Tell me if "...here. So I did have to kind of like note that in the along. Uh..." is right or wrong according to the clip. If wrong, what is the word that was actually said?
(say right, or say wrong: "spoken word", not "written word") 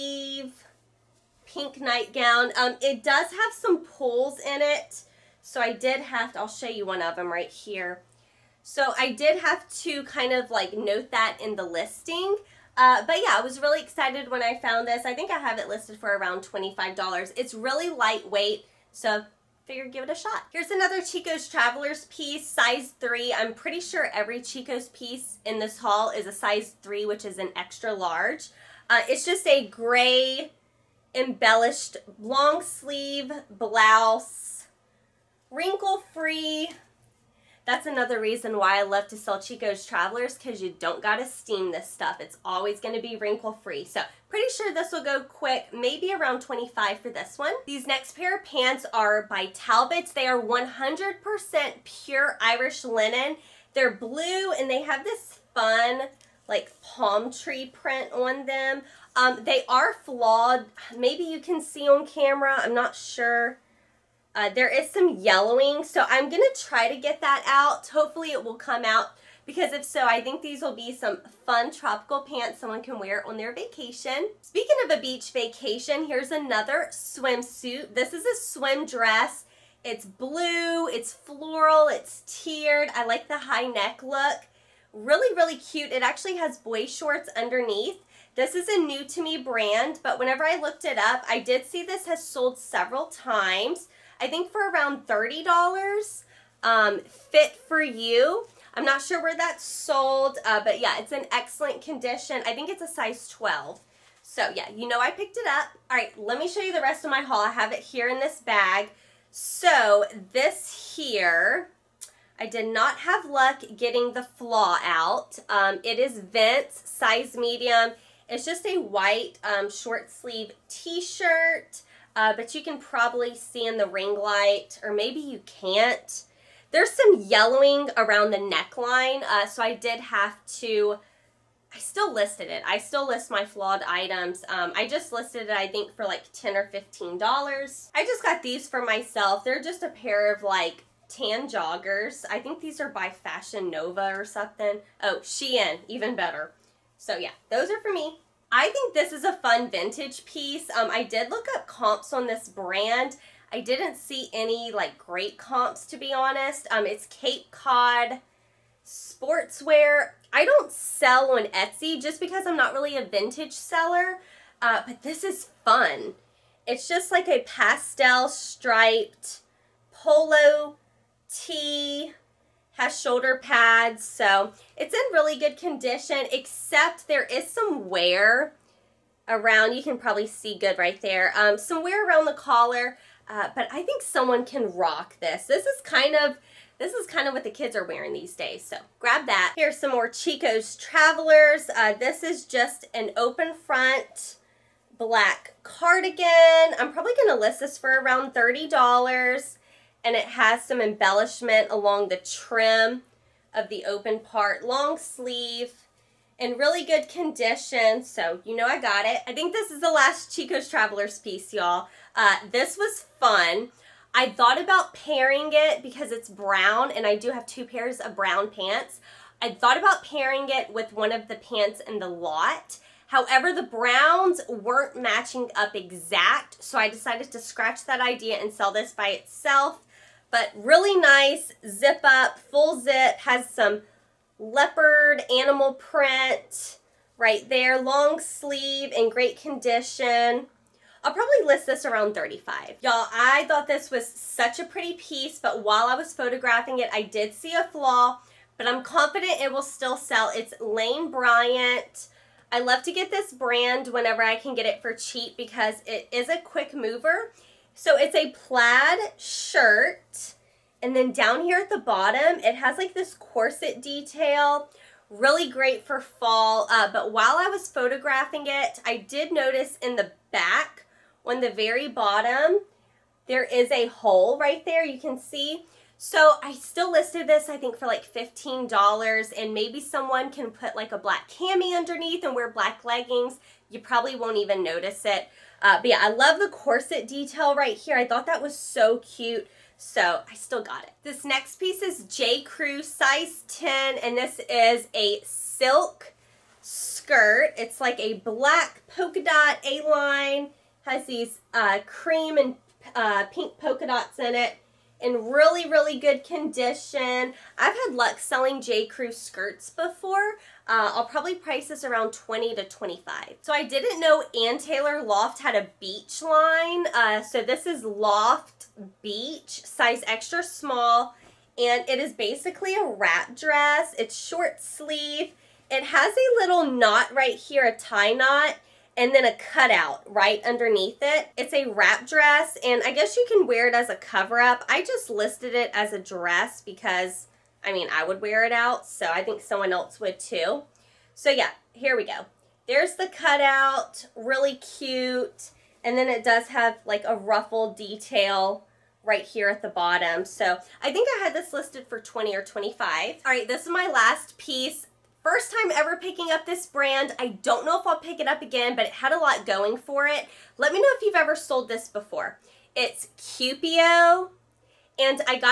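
wrong: "listing", not "along".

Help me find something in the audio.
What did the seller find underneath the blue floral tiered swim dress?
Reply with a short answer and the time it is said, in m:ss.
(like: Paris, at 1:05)
boy shorts, at 1:26.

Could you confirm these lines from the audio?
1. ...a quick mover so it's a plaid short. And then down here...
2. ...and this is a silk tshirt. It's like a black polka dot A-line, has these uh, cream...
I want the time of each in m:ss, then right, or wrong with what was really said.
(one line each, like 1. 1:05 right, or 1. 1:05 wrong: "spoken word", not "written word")
1. 4:16 wrong: "shirt", not "short"
2. 4:53 wrong: "skirt", not "tshirt".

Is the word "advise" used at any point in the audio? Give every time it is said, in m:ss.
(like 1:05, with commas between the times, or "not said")
not said.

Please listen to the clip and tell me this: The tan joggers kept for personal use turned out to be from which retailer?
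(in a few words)
Shein.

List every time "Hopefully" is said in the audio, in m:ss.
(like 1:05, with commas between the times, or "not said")
1:07.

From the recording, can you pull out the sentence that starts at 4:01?
I'll probably list this around 35.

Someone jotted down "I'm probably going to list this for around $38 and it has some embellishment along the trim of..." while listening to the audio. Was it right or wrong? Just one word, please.
wrong.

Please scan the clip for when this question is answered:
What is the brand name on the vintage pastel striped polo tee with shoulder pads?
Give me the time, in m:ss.
2:37.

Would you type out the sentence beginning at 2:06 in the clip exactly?
There's some yellowing around the neckline, uh, so I did have to, I still listed it.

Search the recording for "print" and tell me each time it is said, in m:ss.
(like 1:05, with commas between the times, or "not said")
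0:57, 3:55.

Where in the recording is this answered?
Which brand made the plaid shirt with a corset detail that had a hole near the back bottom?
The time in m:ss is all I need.
4:10.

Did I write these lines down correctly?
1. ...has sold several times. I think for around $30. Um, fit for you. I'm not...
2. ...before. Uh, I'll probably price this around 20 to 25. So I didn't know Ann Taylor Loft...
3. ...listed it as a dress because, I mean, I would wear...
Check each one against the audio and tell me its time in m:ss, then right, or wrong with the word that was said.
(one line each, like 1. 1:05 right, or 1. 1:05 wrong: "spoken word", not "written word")
1. 1:32 right
2. 5:09 right
3. 5:35 right.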